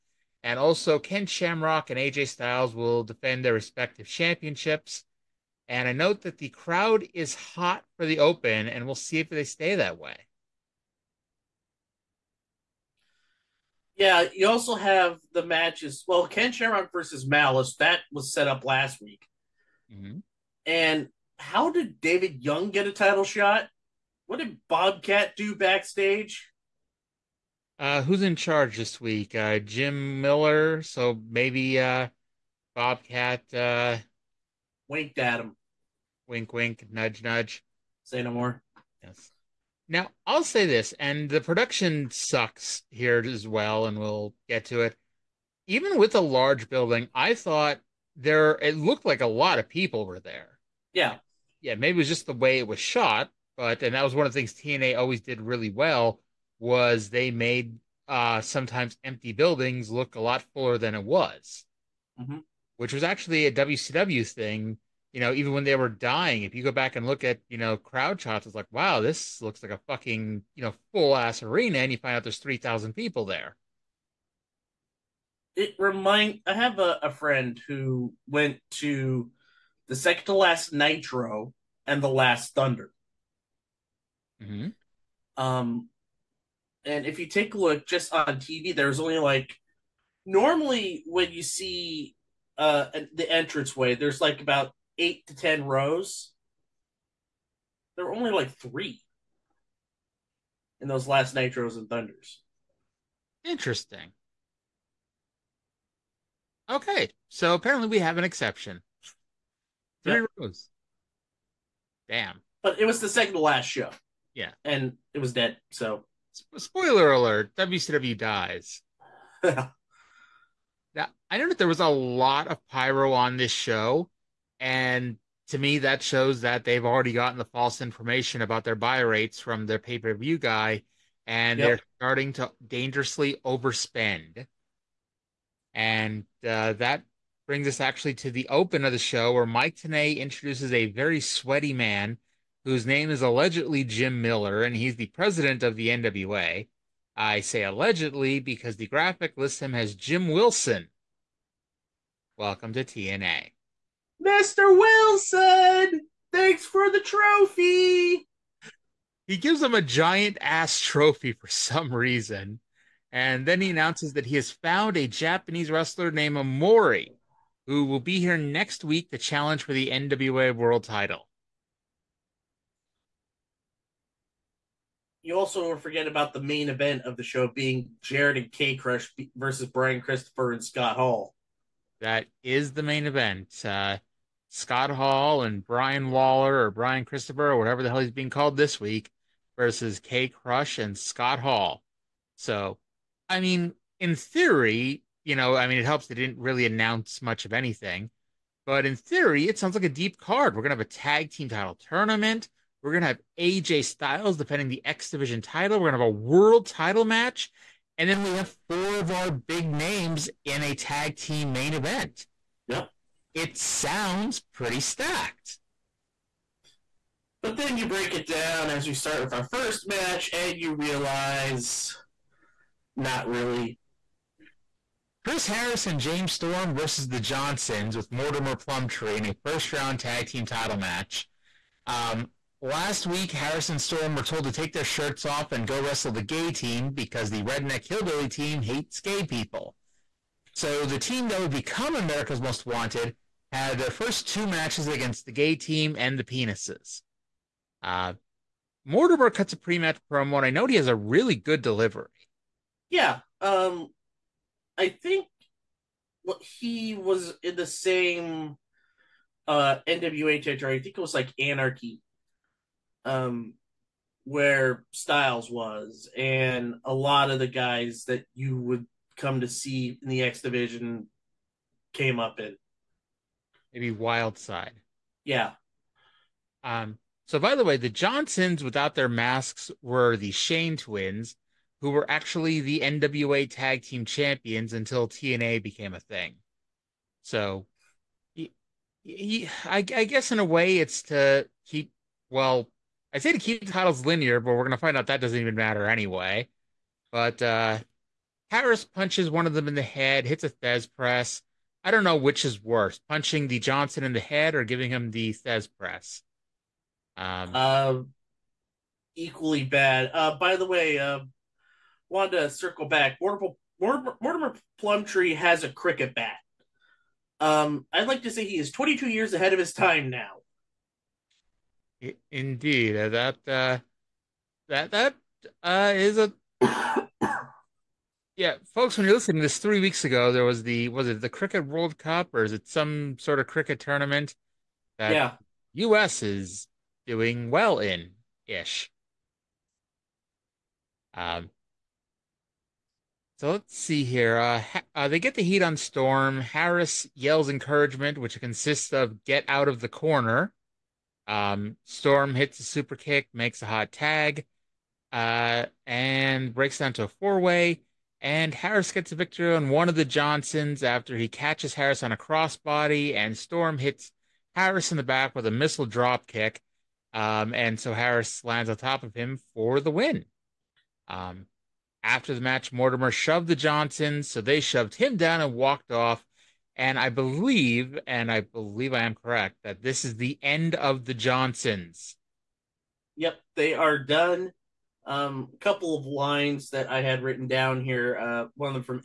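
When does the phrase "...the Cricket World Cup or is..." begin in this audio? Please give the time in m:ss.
5:31.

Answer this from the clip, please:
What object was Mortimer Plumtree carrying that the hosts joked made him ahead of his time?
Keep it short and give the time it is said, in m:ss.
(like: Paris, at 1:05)
a cricket bat, at 5:15.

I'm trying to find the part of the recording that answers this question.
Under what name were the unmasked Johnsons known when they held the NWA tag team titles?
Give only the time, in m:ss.
4:40.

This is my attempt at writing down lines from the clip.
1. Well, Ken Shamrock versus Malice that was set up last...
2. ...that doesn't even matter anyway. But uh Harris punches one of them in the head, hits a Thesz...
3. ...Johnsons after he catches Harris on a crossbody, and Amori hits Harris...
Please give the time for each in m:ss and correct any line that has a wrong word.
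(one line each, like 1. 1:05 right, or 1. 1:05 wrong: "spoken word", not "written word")
1. 0:16 right
2. 4:55 right
3. 6:00 wrong: "Storm", not "Amori".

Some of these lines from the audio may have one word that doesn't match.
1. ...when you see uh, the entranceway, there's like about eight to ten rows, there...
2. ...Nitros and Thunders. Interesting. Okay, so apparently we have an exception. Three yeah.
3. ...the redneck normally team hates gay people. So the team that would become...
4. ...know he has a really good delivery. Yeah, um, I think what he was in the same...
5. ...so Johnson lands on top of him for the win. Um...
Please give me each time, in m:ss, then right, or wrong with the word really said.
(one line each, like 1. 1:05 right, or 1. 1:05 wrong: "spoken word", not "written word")
1. 1:31 right
2. 1:41 right
3. 3:57 wrong: "hillbilly", not "normally"
4. 4:10 right
5. 6:07 wrong: "Harris", not "Johnson".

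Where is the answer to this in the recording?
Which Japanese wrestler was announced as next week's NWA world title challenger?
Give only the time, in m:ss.
2:46.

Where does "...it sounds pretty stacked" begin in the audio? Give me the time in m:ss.
3:33.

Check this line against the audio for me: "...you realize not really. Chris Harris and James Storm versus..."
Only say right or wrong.
right.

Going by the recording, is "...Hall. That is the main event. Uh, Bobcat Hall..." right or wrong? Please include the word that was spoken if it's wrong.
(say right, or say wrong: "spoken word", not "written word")
wrong: "Scott", not "Bobcat".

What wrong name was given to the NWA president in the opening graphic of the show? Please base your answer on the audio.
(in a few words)
Jim Wilson.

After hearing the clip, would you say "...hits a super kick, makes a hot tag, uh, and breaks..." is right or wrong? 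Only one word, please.
right.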